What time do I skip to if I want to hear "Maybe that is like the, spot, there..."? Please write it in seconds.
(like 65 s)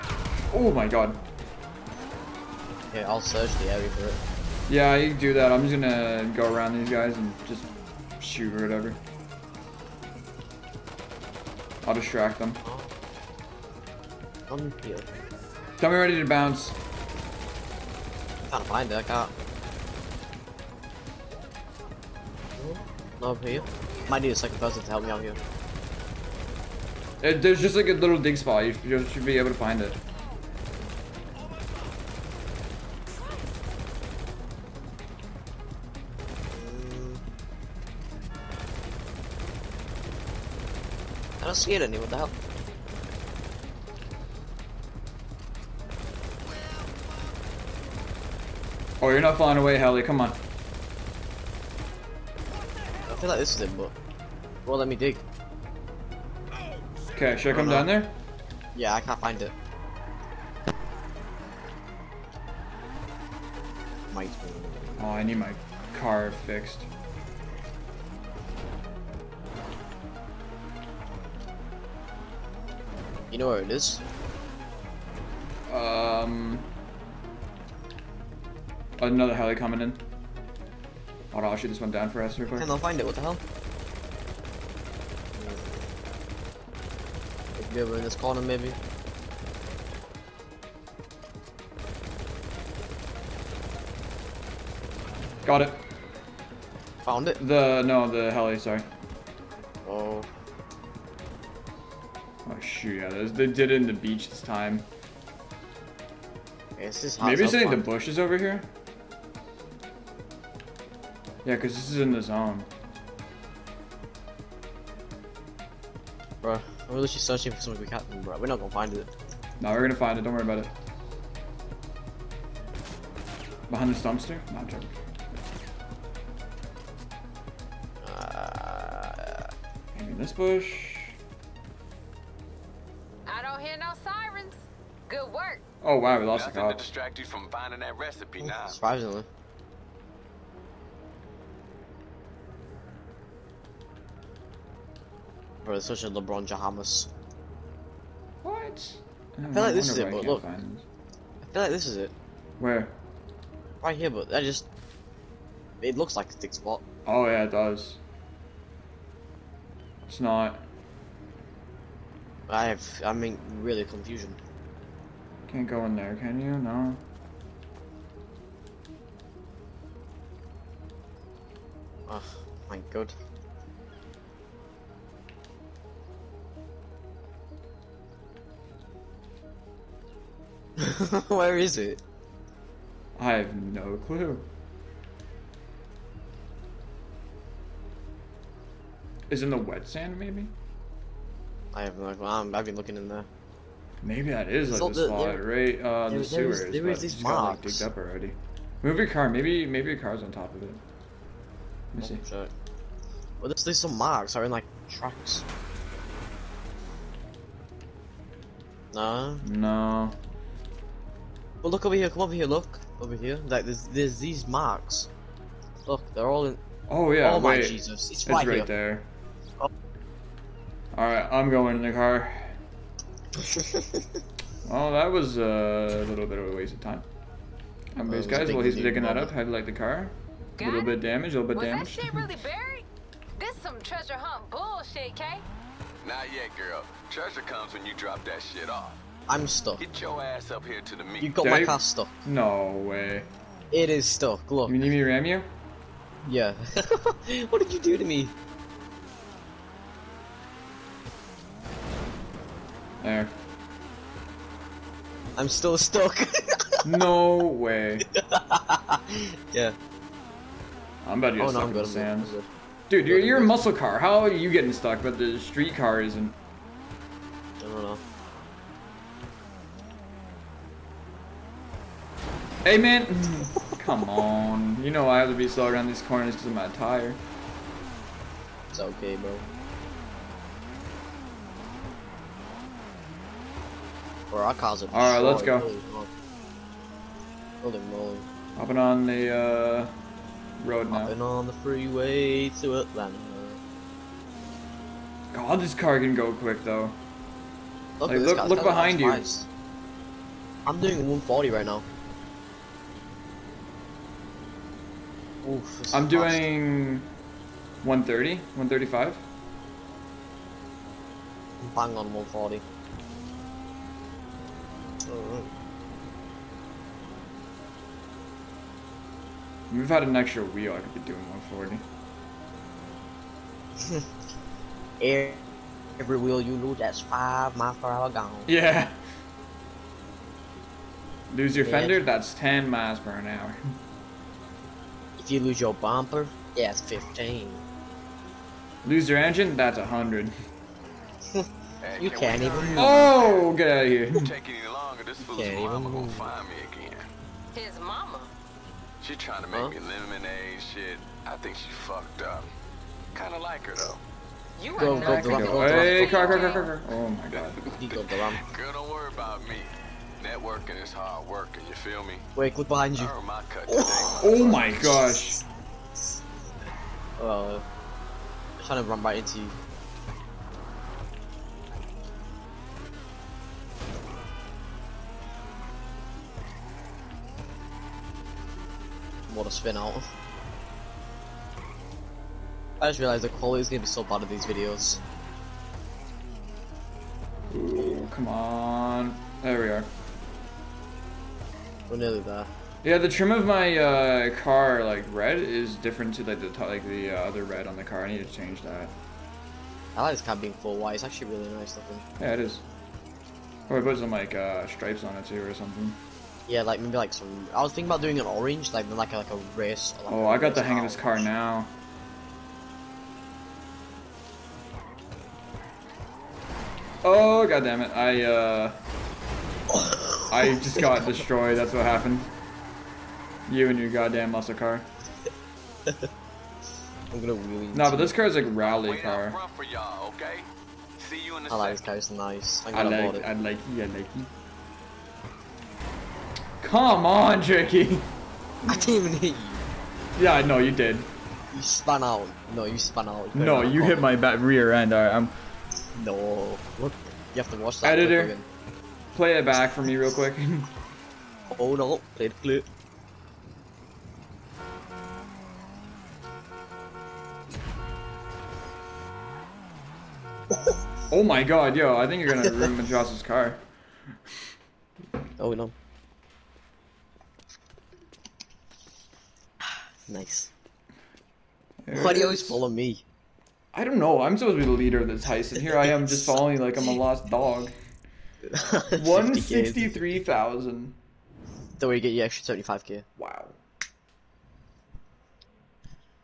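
194 s.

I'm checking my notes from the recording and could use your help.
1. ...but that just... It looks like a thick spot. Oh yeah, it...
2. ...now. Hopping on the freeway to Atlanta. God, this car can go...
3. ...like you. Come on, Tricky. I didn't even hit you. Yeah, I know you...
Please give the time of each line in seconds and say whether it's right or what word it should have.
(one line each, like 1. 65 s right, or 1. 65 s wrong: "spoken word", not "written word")
1. 154 s right
2. 290 s right
3. 433 s right.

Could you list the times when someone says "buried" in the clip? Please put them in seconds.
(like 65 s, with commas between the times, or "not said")
232 s.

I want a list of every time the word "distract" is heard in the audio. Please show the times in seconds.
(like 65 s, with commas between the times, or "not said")
11 s, 136 s.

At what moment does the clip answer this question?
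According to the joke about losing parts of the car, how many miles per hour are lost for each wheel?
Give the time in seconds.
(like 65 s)
327 s.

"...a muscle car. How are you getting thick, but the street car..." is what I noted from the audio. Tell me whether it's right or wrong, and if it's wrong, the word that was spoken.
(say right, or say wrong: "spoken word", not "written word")
wrong: "stuck", not "thick".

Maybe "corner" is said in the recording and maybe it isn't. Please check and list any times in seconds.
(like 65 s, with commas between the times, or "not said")
88 s, 276 s.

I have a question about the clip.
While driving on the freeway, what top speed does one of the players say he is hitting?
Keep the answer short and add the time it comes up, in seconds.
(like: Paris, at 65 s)
140, at 300 s.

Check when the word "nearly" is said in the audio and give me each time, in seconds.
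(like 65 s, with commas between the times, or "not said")
391 s.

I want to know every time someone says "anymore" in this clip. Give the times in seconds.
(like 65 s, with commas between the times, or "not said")
41 s.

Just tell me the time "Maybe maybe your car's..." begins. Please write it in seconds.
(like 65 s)
199 s.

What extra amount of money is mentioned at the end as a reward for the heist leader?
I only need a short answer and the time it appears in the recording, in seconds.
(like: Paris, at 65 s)
75k, at 482 s.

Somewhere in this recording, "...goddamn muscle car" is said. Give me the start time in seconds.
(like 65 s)
423 s.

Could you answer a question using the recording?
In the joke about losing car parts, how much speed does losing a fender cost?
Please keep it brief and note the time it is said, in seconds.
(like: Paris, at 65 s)
10 miles per hour, at 332 s.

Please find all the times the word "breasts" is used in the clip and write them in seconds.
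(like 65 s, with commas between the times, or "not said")
not said.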